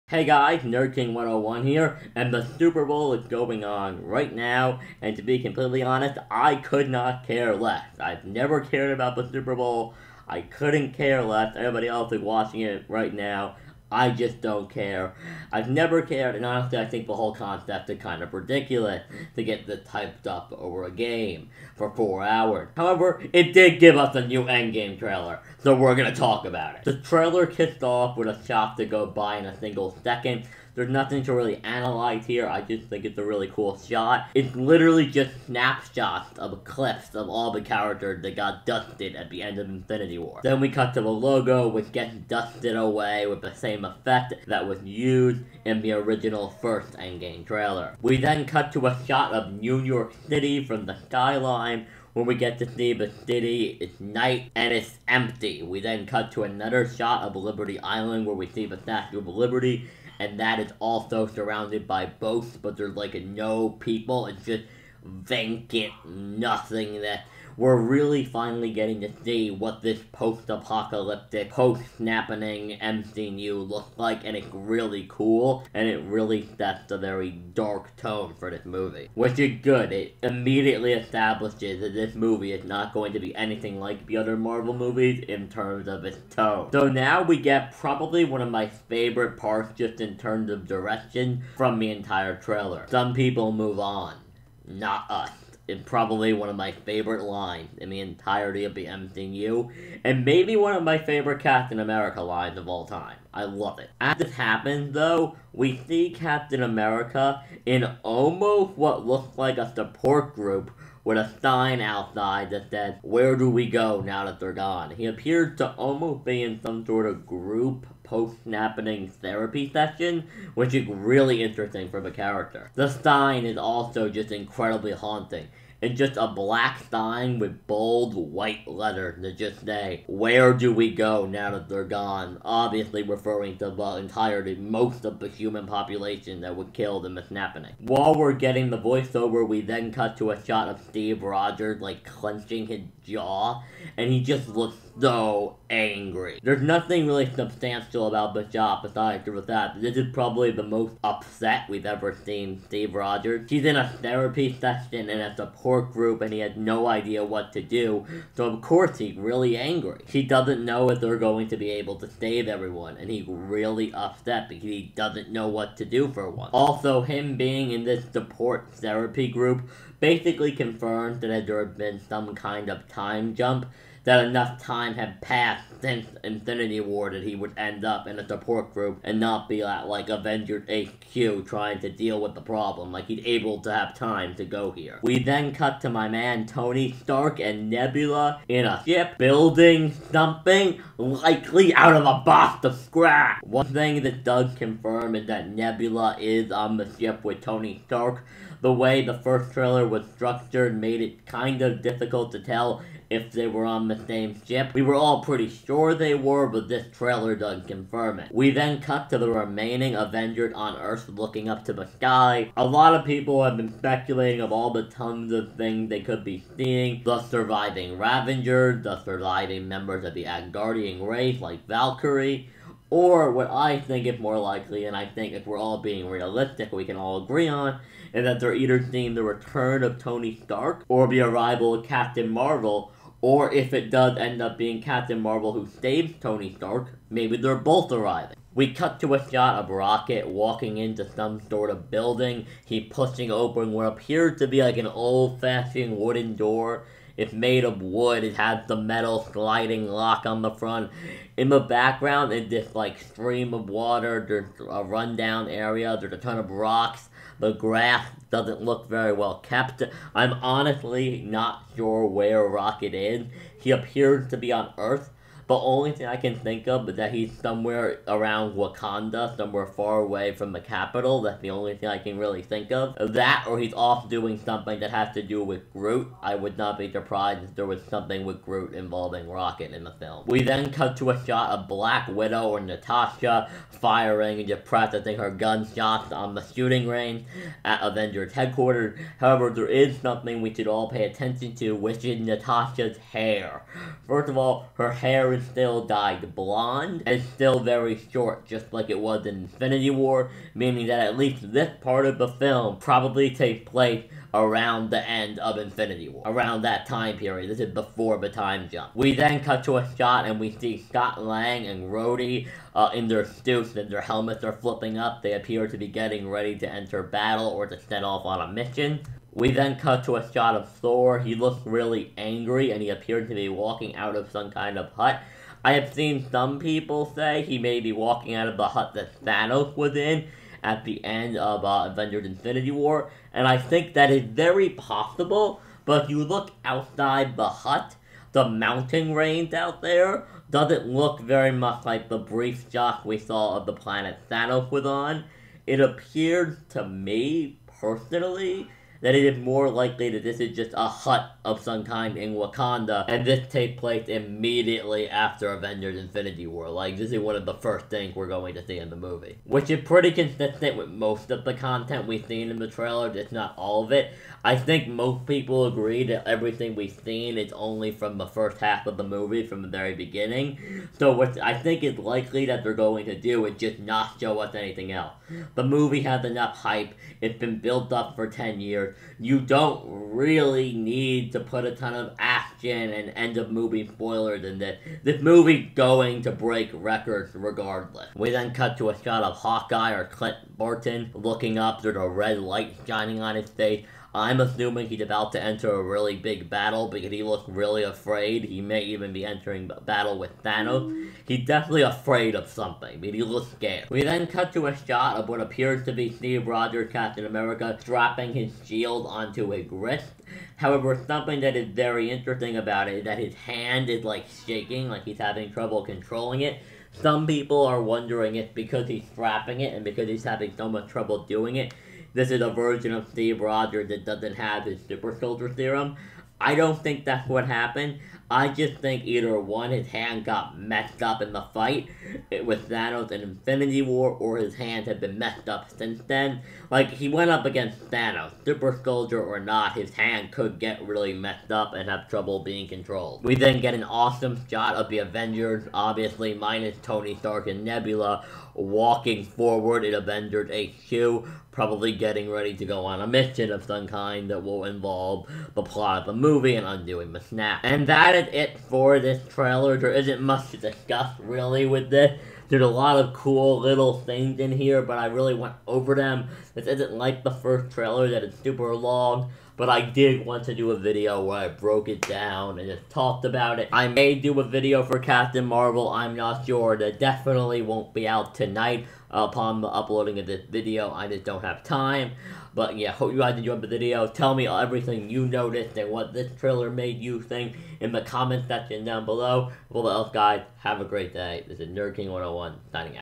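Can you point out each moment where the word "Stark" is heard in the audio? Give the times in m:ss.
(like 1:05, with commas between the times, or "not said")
3:07, 3:17, 3:50, 3:56, 7:27.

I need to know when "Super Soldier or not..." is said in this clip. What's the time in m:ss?
7:18.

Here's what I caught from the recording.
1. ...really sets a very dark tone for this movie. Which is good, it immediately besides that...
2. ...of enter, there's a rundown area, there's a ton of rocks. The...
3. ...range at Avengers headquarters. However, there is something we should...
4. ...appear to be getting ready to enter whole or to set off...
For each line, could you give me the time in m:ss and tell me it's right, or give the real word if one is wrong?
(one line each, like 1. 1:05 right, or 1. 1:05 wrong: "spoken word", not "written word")
1. 1:16 wrong: "establishes", not "besides"
2. 4:13 wrong: "water", not "enter"
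3. 4:46 right
4. 5:15 wrong: "battle", not "whole".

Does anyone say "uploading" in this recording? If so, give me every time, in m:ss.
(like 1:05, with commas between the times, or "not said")
7:59.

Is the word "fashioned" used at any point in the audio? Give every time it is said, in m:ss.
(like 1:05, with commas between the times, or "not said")
4:05.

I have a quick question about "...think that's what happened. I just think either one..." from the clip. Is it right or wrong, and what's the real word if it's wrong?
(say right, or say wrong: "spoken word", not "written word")
right.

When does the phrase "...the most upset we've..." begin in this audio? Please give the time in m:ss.
2:30.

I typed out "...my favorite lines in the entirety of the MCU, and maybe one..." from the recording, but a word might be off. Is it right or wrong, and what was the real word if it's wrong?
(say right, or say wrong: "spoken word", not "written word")
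right.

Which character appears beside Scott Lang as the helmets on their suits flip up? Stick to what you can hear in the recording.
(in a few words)
Rhodey.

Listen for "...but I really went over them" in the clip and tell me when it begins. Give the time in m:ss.
7:44.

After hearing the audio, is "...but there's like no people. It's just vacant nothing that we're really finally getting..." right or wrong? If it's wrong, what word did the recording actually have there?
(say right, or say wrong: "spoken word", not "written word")
right.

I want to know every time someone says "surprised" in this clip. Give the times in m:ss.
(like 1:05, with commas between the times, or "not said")
4:36.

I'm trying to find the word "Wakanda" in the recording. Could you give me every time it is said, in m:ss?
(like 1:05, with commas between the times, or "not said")
4:28, 5:52.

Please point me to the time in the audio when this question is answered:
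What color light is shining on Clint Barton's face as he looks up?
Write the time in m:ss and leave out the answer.
6:32.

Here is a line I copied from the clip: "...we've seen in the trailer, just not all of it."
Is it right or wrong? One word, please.
right.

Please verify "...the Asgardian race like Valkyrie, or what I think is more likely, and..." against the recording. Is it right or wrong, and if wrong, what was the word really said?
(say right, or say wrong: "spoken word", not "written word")
right.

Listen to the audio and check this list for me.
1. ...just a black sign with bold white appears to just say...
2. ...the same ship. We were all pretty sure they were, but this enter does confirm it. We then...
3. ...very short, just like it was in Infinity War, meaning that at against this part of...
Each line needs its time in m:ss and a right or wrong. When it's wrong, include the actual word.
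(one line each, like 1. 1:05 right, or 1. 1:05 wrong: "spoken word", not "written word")
1. 2:05 wrong: "letters", not "appears"
2. 3:23 wrong: "trailer", not "enter"
3. 4:57 wrong: "least", not "against".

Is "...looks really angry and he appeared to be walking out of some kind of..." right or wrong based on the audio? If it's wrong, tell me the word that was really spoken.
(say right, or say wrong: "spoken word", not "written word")
right.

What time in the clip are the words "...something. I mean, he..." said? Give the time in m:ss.
6:42.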